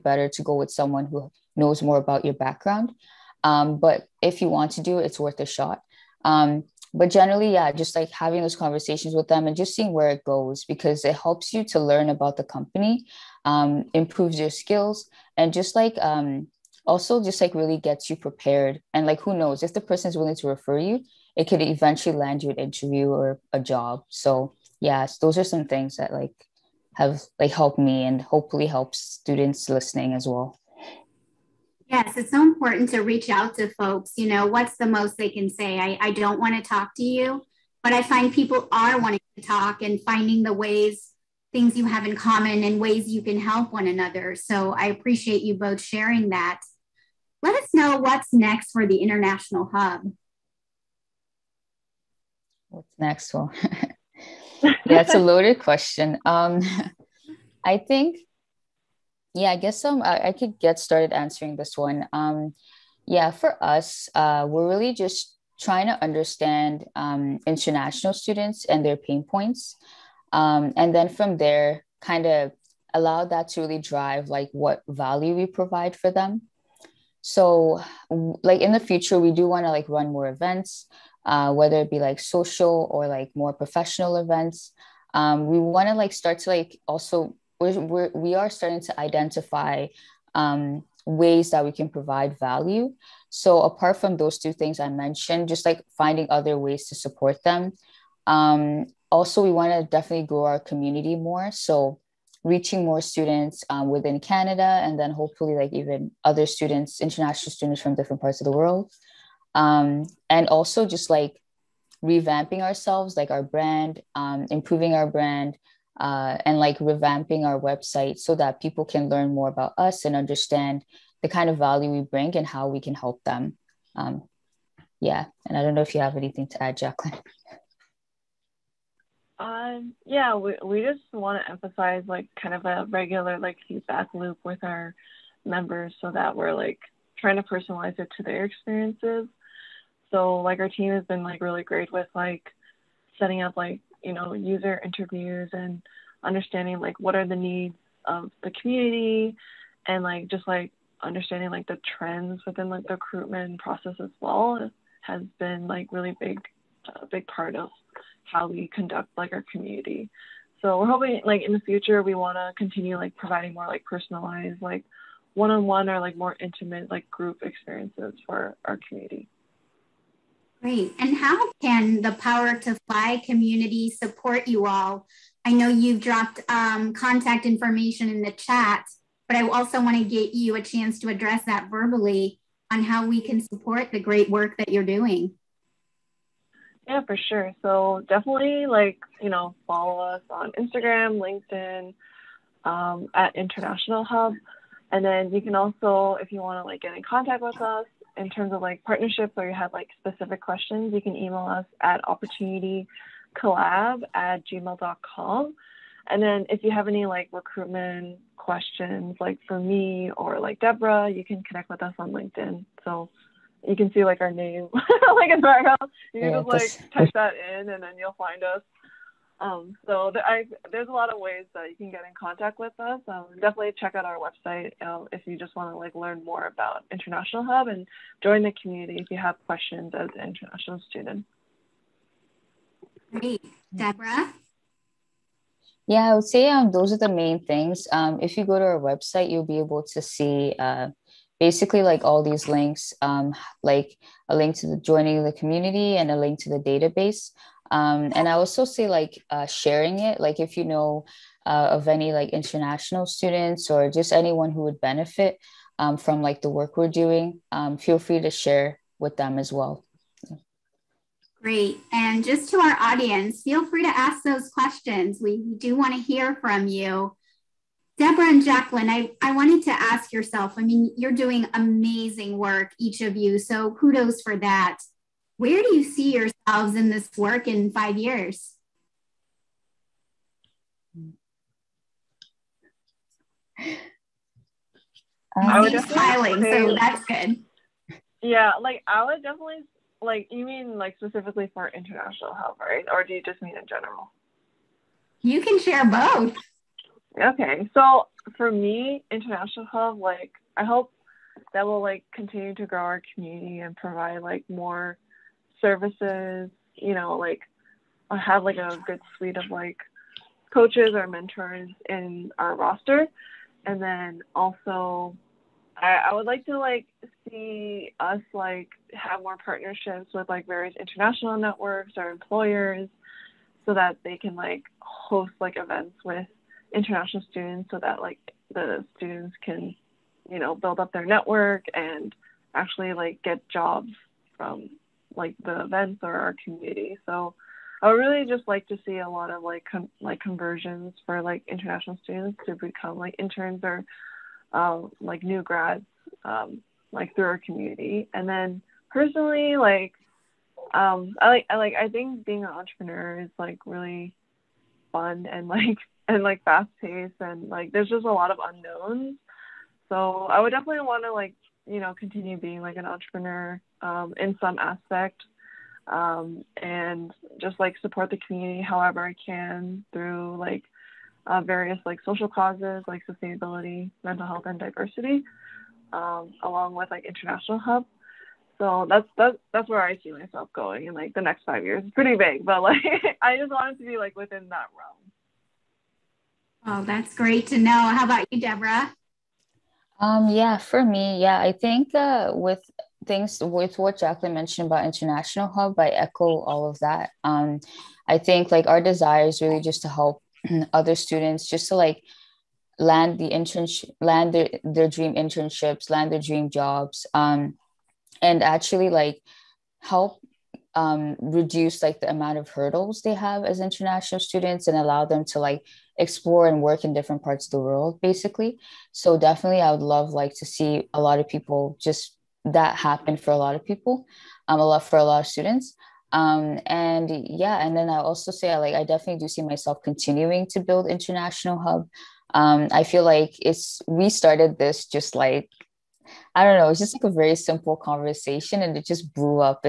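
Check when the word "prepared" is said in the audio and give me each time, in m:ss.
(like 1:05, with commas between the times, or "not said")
0:18.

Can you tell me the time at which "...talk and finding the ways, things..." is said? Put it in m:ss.
0:39.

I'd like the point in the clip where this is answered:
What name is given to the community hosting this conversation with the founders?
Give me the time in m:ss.
2:52.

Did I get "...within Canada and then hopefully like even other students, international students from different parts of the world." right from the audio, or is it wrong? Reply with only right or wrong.
right.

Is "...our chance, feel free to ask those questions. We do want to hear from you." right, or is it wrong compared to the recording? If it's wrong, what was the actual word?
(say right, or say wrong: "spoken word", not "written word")
wrong: "audience", not "chance".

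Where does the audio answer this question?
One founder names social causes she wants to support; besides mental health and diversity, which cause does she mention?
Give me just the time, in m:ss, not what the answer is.
6:13.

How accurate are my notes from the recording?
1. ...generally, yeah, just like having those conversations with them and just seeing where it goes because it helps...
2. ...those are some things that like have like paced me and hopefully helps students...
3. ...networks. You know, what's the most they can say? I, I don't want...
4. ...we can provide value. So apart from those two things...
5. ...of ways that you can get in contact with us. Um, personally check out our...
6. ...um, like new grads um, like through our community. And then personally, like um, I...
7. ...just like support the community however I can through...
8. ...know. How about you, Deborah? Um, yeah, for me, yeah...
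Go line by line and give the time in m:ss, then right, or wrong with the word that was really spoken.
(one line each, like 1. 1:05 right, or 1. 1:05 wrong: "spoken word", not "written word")
1. 0:07 right
2. 0:25 wrong: "helped", not "paced"
3. 0:33 wrong: "folks", not "networks"
4. 1:31 right
5. 3:41 wrong: "definitely", not "personally"
6. 5:44 right
7. 6:07 right
8. 6:27 right.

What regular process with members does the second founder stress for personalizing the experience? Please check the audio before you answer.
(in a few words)
Feedback loop.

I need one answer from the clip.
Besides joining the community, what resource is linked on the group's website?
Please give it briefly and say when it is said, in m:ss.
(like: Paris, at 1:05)
Database, at 4:06.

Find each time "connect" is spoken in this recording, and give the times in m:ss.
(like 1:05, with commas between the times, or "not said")
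3:31.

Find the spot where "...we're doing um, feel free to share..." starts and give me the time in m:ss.
4:16.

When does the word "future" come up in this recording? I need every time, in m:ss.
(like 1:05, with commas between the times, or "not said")
1:18, 2:41.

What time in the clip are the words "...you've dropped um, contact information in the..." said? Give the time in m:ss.
2:55.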